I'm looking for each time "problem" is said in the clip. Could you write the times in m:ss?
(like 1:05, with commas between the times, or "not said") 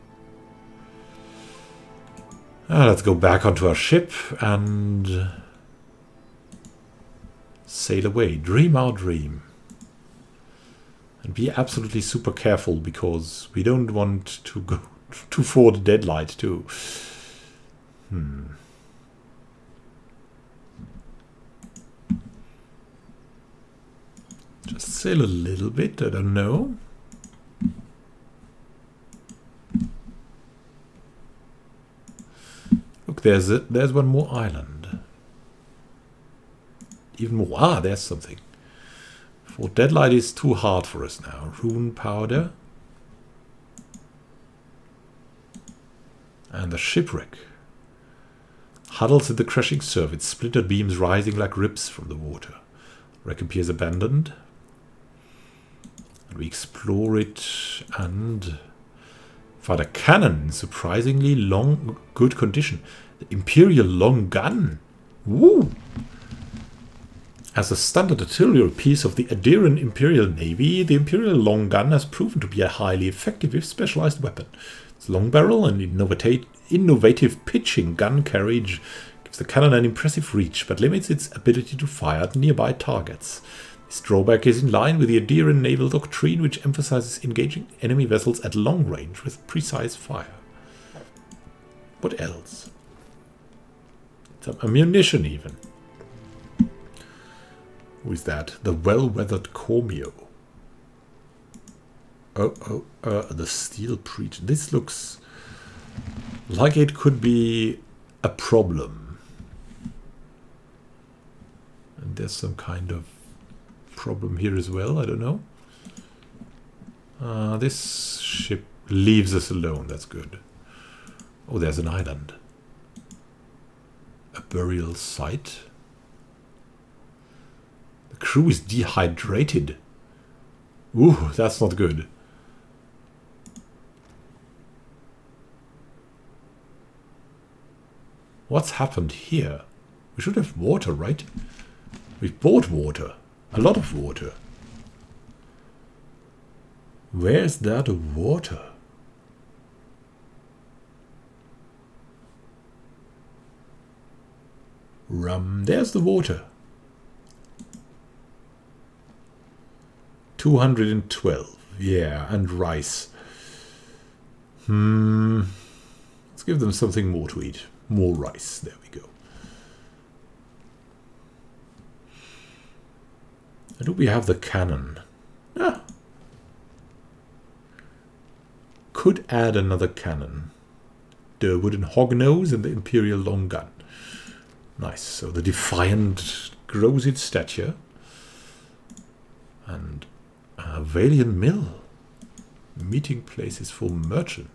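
1:48, 1:54.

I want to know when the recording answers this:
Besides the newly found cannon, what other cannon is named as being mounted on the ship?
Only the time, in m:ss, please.
3:01.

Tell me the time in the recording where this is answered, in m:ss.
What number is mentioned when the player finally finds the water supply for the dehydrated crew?
2:40.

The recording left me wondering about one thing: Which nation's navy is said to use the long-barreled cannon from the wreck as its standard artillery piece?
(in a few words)
Aedyran Imperial Navy.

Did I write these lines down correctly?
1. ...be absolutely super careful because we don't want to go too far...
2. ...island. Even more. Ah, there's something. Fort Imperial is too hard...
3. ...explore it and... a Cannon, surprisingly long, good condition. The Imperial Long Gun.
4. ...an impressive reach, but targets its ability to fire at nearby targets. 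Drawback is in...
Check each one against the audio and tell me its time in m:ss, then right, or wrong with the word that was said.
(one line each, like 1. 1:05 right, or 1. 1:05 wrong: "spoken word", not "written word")
1. 0:11 right
2. 0:34 wrong: "Deadlight", not "Imperial"
3. 0:56 right
4. 1:19 wrong: "limits", not "targets".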